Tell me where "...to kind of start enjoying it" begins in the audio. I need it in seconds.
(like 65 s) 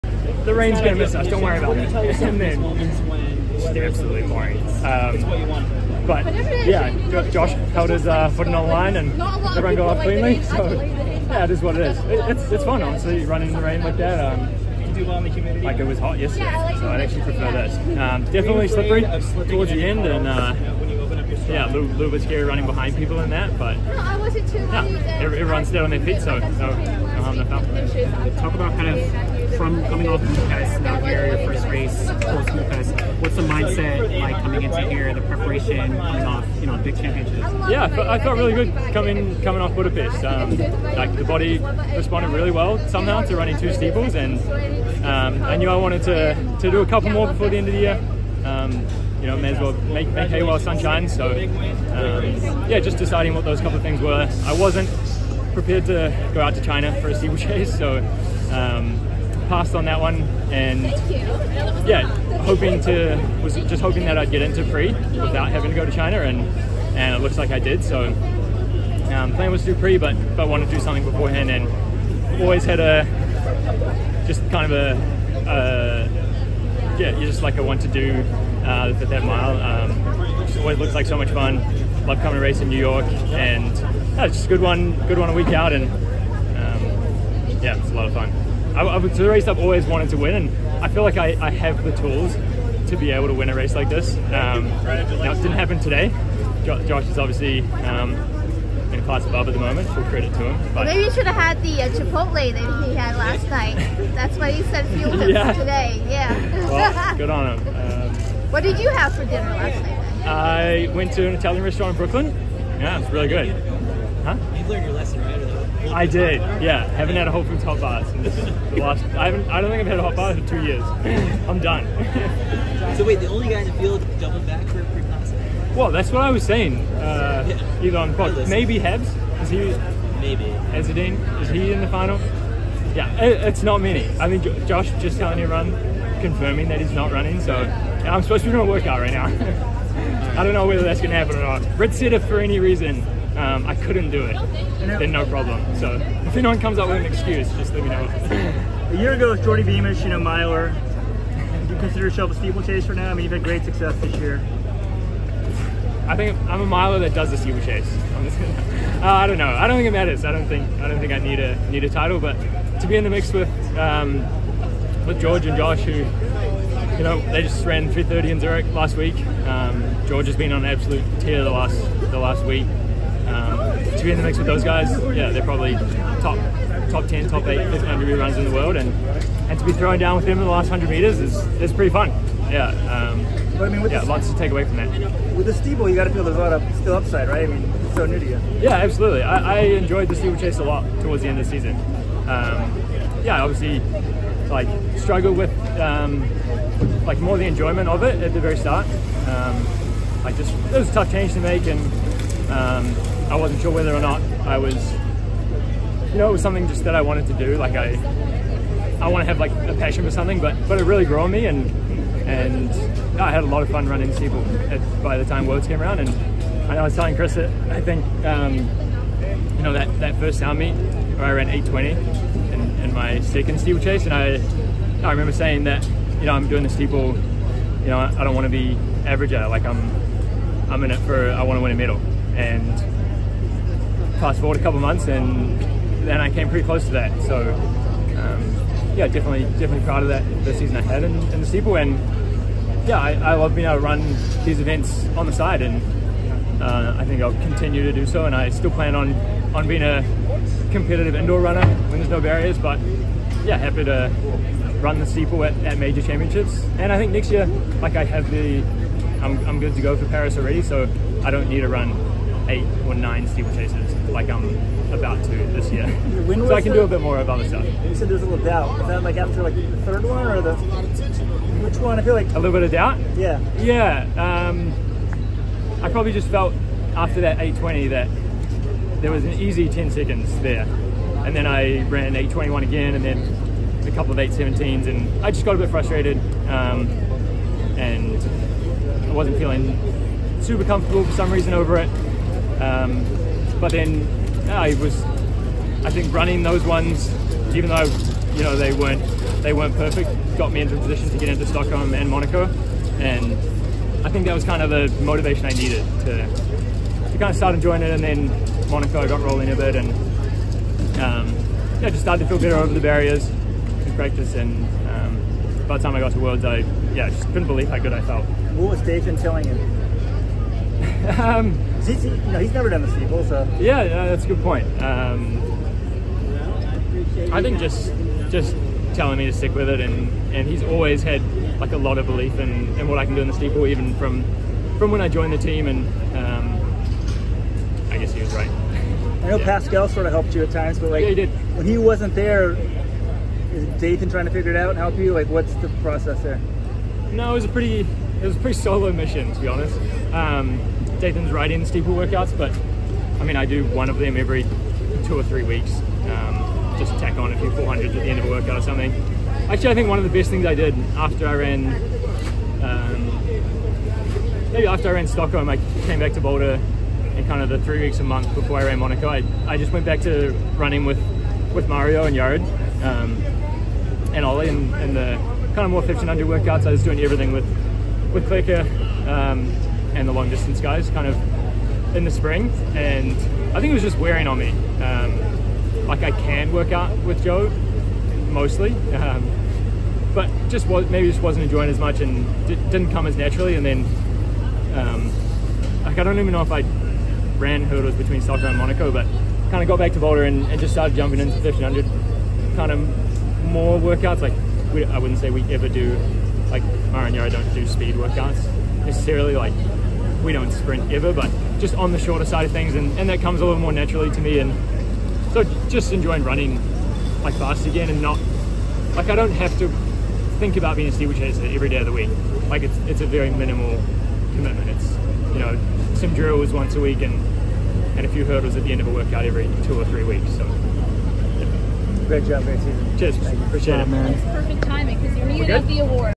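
307 s.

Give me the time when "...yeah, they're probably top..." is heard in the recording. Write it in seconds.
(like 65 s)
175 s.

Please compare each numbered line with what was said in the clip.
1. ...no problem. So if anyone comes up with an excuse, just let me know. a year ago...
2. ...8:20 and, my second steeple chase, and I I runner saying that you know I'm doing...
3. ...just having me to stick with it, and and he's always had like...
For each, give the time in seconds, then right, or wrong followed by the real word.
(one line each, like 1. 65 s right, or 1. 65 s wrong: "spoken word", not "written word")
1. 145 s right
2. 221 s wrong: "remember", not "runner"
3. 328 s wrong: "telling", not "having".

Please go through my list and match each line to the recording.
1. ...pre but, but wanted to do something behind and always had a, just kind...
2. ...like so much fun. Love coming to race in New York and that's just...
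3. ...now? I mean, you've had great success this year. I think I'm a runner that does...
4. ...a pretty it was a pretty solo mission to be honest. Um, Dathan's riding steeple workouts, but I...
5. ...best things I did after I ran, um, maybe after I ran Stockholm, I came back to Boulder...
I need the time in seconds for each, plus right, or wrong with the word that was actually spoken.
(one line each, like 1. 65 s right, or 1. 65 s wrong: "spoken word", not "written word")
1. 69 s wrong: "beforehand", not "behind"
2. 80 s right
3. 152 s wrong: "miler", not "runner"
4. 347 s right
5. 360 s right.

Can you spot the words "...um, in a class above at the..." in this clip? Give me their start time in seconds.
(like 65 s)
97 s.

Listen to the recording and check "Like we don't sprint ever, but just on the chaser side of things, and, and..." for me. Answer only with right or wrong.
wrong.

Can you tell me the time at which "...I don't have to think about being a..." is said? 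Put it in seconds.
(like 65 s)
419 s.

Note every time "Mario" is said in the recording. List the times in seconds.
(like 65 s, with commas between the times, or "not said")
371 s, 406 s.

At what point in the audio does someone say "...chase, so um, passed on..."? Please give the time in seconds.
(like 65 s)
57 s.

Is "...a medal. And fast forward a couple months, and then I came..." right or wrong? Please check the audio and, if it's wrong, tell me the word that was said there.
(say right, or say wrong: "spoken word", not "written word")
right.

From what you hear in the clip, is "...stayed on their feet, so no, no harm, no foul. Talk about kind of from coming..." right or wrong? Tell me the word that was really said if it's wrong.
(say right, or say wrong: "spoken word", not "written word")
right.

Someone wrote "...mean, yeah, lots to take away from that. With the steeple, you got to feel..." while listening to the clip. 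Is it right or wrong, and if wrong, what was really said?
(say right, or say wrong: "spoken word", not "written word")
right.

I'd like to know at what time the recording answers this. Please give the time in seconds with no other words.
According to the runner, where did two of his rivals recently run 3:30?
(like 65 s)
168 s.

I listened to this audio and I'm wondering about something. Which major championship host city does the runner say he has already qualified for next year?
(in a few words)
Paris.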